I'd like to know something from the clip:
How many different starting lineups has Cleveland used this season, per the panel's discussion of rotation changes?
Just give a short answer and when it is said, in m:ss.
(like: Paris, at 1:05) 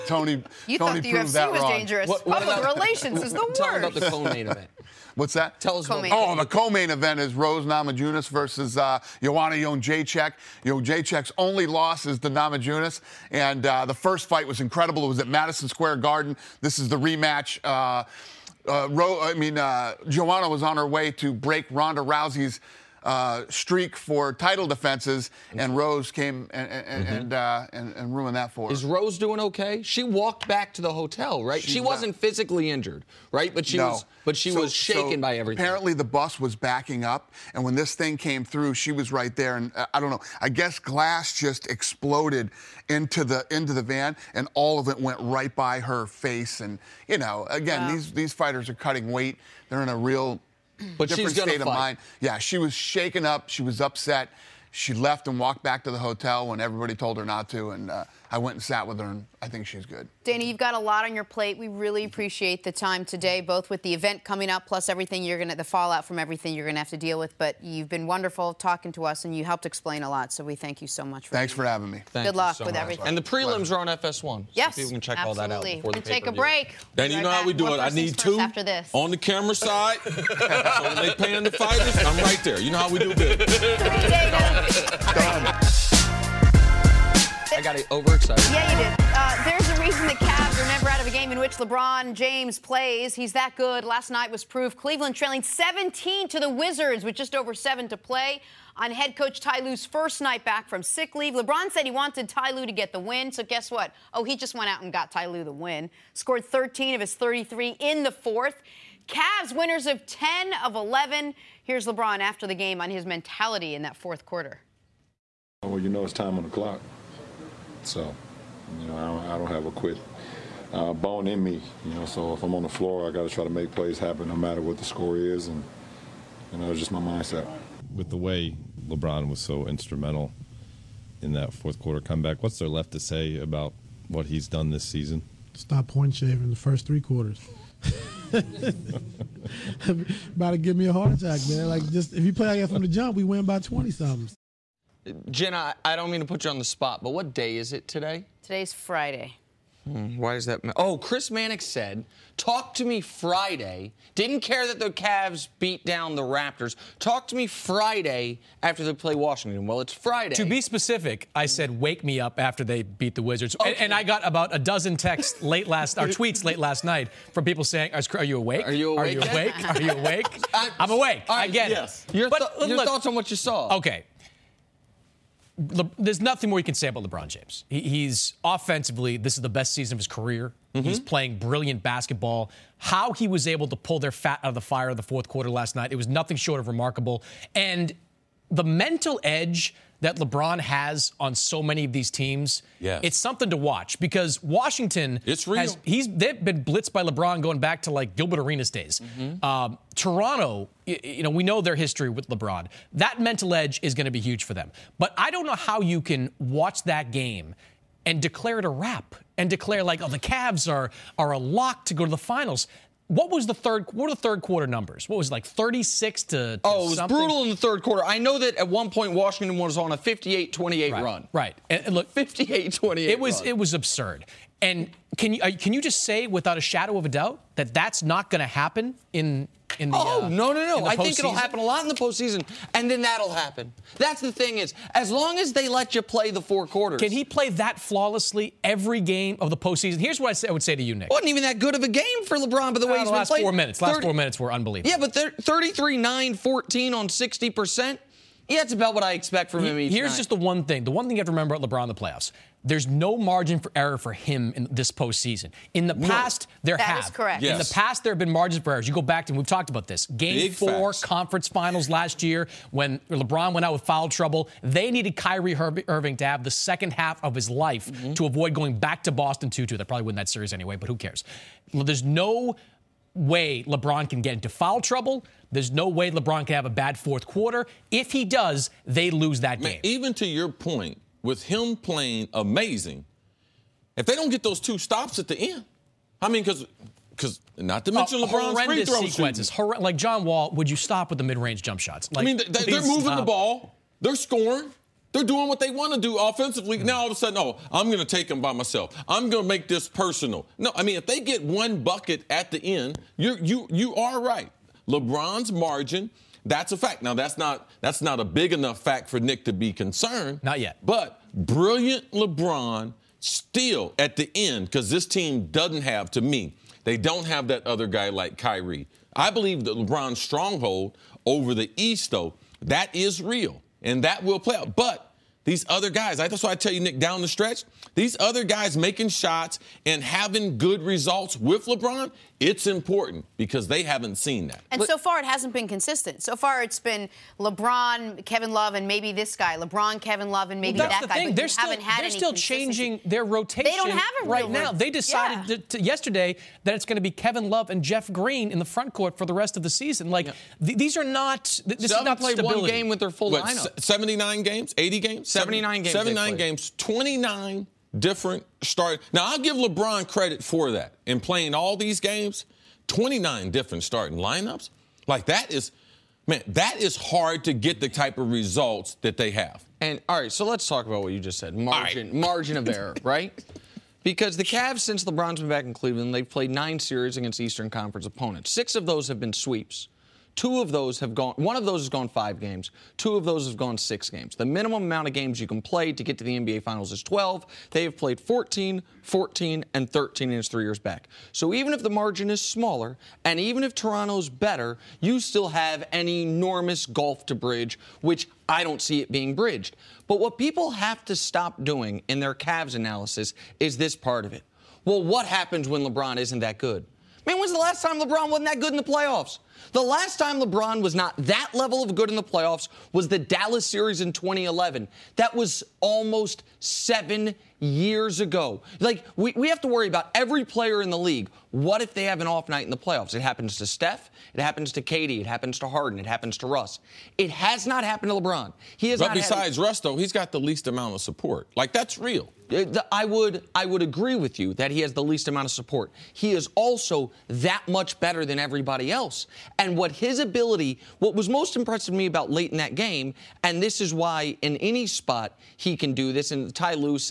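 29, at 6:02.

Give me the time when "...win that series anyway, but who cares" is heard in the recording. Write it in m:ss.
4:30.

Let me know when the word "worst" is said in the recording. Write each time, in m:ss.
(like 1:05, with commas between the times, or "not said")
0:03.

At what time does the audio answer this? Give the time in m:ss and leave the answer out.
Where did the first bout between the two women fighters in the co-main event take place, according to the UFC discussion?
0:15.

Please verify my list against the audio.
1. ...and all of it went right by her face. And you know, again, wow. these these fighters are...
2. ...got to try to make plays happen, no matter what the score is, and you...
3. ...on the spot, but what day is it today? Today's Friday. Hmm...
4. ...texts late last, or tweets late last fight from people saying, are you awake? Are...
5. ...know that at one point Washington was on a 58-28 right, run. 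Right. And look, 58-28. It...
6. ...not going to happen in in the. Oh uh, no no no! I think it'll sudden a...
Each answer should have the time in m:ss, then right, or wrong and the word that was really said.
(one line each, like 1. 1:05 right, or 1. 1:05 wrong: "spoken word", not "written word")
1. 0:44 right
2. 2:03 right
3. 2:26 right
4. 2:44 wrong: "night", not "fight"
5. 3:38 right
6. 3:48 wrong: "happen", not "sudden".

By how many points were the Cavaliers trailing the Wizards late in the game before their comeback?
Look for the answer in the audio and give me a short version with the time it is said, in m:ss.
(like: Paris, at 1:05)
17, at 1:35.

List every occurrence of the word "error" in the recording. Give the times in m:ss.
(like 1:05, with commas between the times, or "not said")
4:13, 4:18, 6:12.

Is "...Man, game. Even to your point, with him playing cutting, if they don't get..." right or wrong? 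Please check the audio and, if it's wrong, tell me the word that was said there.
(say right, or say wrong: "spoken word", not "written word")
wrong: "amazing", not "cutting".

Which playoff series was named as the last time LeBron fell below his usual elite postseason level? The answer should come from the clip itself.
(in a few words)
Dallas series in 2011.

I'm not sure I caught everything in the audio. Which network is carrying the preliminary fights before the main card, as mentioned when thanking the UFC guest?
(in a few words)
FS1.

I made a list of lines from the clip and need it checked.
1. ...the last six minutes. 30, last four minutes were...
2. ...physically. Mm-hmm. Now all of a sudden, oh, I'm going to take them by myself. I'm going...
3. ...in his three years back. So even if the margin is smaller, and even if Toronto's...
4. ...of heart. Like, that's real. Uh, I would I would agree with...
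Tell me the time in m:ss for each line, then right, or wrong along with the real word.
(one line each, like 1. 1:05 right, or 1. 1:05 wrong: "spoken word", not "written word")
1. 4:03 wrong: "four", not "six"
2. 4:56 wrong: "offensively", not "physically"
3. 6:30 right
4. 7:10 wrong: "support", not "heart".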